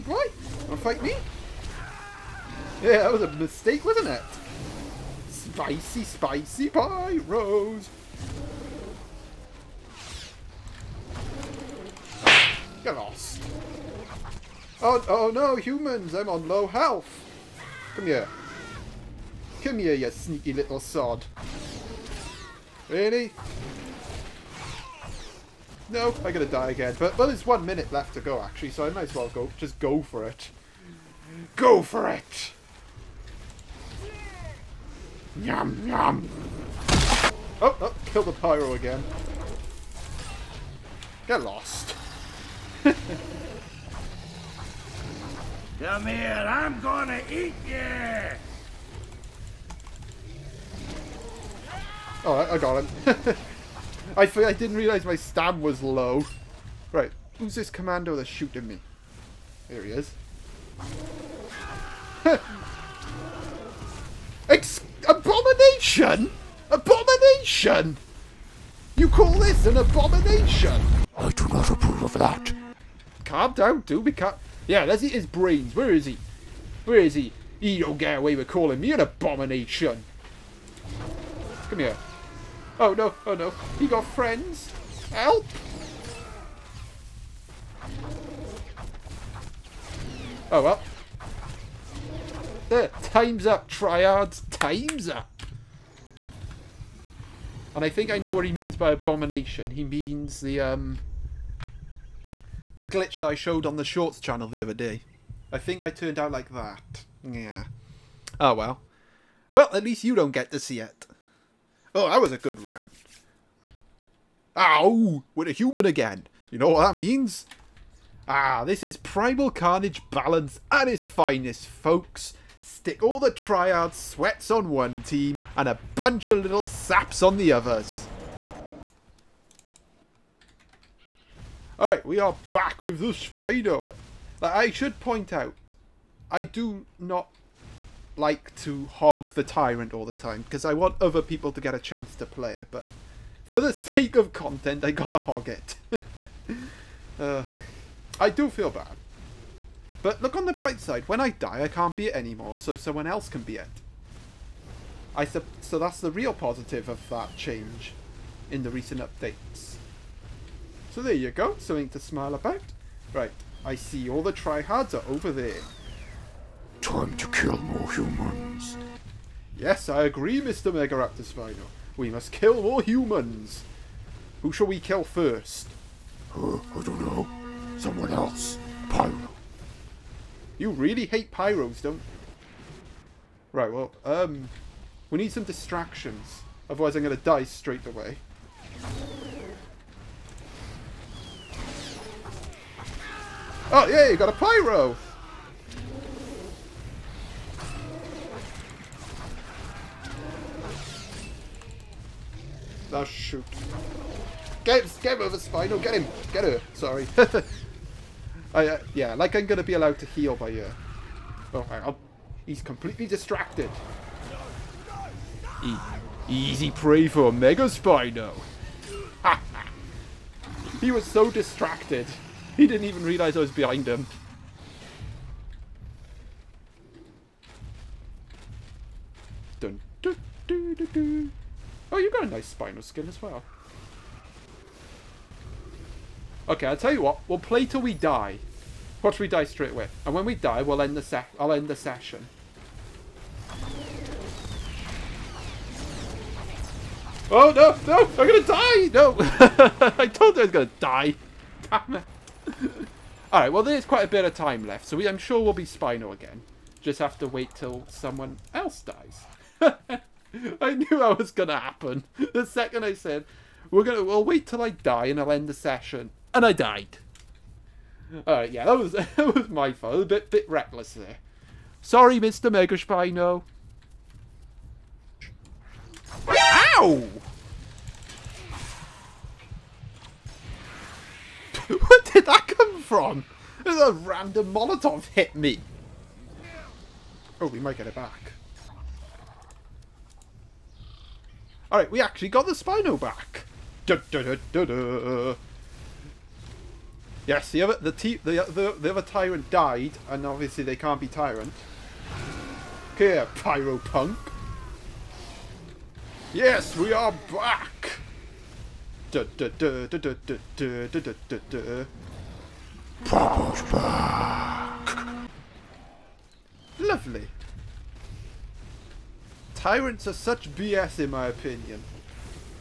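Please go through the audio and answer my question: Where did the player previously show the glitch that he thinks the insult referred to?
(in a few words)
The Shorts channel.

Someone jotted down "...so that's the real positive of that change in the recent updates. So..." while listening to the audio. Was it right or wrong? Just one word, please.
right.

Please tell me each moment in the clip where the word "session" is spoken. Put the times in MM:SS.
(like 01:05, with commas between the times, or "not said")
04:01, 04:25.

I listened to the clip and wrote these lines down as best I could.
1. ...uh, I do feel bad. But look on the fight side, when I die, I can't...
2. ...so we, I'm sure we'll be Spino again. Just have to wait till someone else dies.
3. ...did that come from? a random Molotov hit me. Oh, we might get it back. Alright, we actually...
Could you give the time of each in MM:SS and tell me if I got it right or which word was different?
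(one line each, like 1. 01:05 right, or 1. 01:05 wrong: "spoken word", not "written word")
1. 02:27 wrong: "bright", not "fight"
2. 04:14 right
3. 04:42 right.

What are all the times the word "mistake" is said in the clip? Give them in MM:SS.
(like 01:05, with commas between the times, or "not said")
00:03.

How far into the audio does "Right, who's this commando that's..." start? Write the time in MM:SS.
00:56.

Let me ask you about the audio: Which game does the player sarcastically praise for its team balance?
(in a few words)
Primal Carnage.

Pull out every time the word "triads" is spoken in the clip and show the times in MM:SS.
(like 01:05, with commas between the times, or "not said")
01:33, 02:03.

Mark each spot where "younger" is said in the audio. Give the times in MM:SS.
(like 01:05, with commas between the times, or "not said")
not said.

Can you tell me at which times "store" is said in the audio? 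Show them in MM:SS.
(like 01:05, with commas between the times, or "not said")
not said.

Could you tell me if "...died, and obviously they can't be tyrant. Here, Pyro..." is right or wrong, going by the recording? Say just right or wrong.
right.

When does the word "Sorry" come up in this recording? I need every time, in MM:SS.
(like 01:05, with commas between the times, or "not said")
03:26, 04:31.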